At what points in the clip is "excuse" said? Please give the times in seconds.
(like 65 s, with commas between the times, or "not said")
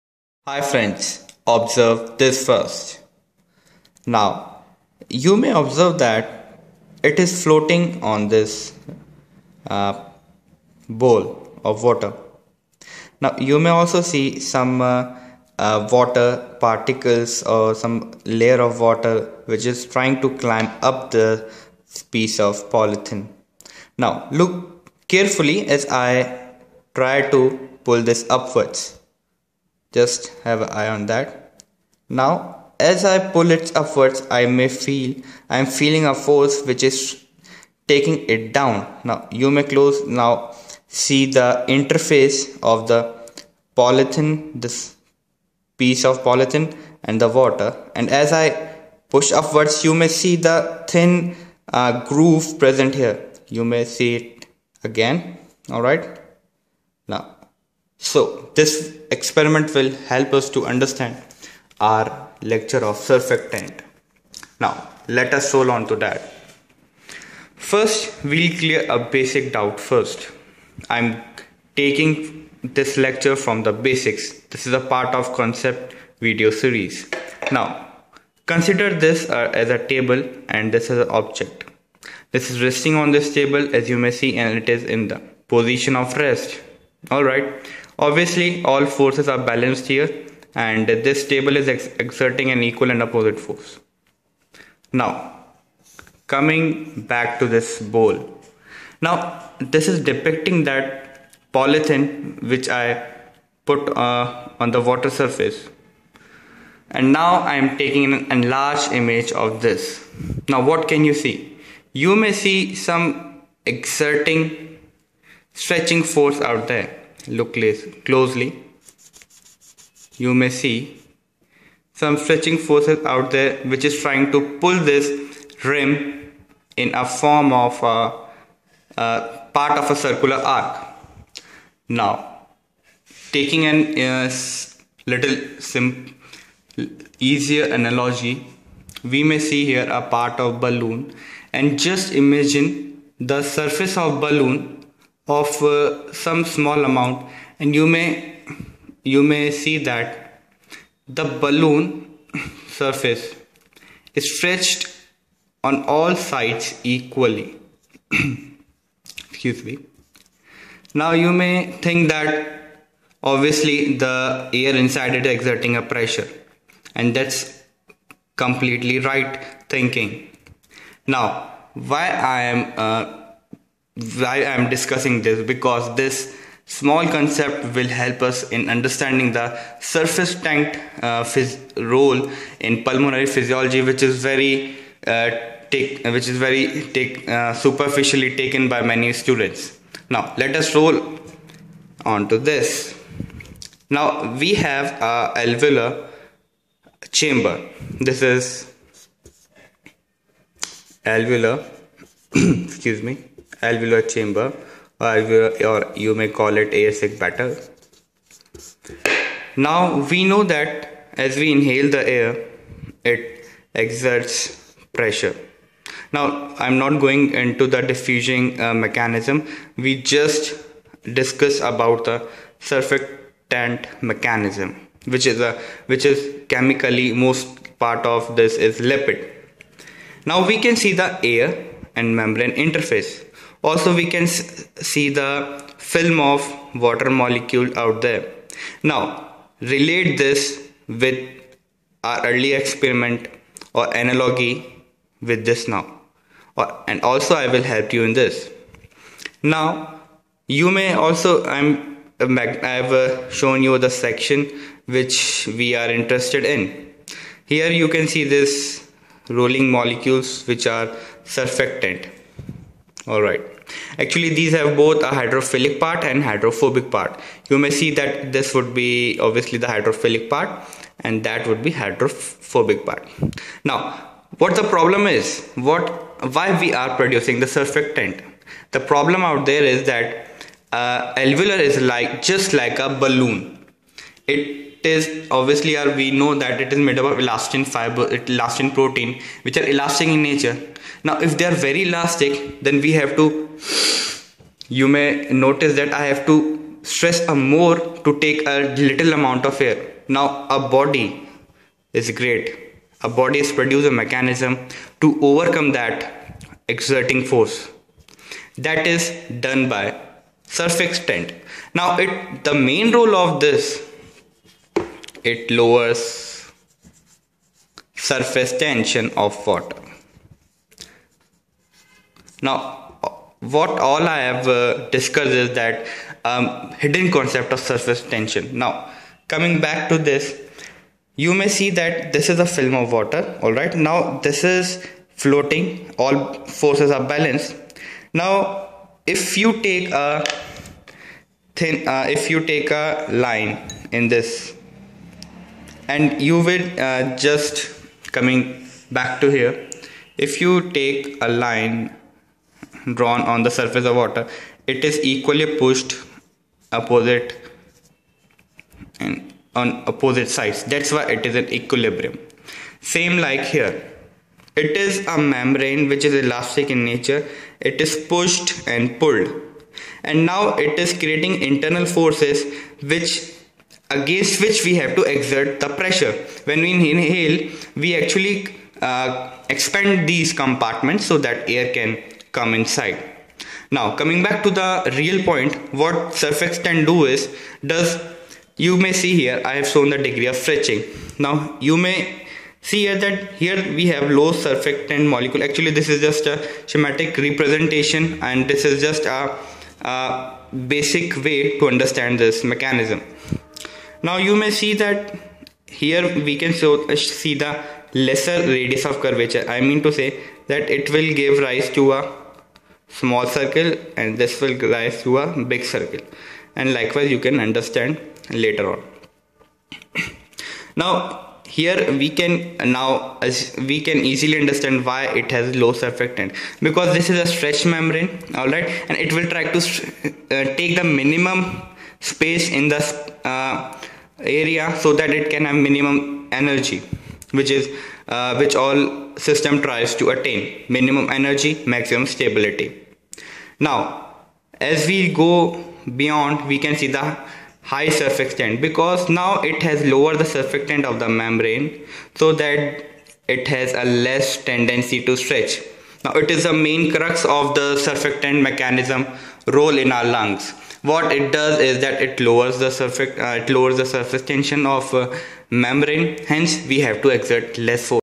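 159 s, 202 s.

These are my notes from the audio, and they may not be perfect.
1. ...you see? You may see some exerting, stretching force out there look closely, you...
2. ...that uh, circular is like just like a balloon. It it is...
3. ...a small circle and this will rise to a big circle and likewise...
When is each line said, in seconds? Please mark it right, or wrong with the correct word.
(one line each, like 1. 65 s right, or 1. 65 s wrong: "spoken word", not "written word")
1. 111 s right
2. 279 s wrong: "alveolar", not "circular"
3. 411 s right.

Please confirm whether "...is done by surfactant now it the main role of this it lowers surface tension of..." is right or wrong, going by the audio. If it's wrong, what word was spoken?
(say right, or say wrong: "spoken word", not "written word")
right.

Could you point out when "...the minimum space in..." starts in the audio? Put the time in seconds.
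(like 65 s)
430 s.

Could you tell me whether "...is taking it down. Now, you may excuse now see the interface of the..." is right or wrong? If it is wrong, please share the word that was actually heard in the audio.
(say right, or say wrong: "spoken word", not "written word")
wrong: "close", not "excuse".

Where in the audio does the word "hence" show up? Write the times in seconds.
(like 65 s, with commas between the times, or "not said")
466 s.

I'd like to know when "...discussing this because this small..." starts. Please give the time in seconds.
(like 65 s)
174 s.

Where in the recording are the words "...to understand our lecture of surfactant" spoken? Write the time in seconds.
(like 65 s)
60 s.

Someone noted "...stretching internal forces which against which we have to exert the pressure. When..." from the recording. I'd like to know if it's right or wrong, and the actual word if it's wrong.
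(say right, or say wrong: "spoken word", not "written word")
wrong: "creating", not "stretching".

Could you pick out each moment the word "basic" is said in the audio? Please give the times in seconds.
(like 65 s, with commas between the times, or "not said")
69 s, 73 s, 400 s.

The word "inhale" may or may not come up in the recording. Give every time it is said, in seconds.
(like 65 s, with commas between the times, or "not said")
211 s, 376 s.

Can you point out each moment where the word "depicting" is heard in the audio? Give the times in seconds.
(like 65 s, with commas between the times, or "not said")
100 s.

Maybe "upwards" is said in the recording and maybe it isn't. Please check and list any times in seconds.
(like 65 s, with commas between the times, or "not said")
28 s, 33 s, 49 s.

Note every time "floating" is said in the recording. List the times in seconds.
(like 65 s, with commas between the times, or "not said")
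7 s, 335 s.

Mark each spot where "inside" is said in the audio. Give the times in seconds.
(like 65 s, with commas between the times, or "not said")
164 s, 382 s.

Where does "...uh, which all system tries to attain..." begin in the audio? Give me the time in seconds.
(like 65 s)
438 s.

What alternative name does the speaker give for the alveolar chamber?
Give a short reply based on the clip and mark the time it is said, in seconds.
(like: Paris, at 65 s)
air sac, at 206 s.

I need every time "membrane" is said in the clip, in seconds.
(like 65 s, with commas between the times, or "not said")
232 s, 365 s, 427 s, 451 s, 465 s.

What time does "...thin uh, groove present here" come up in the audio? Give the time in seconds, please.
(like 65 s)
50 s.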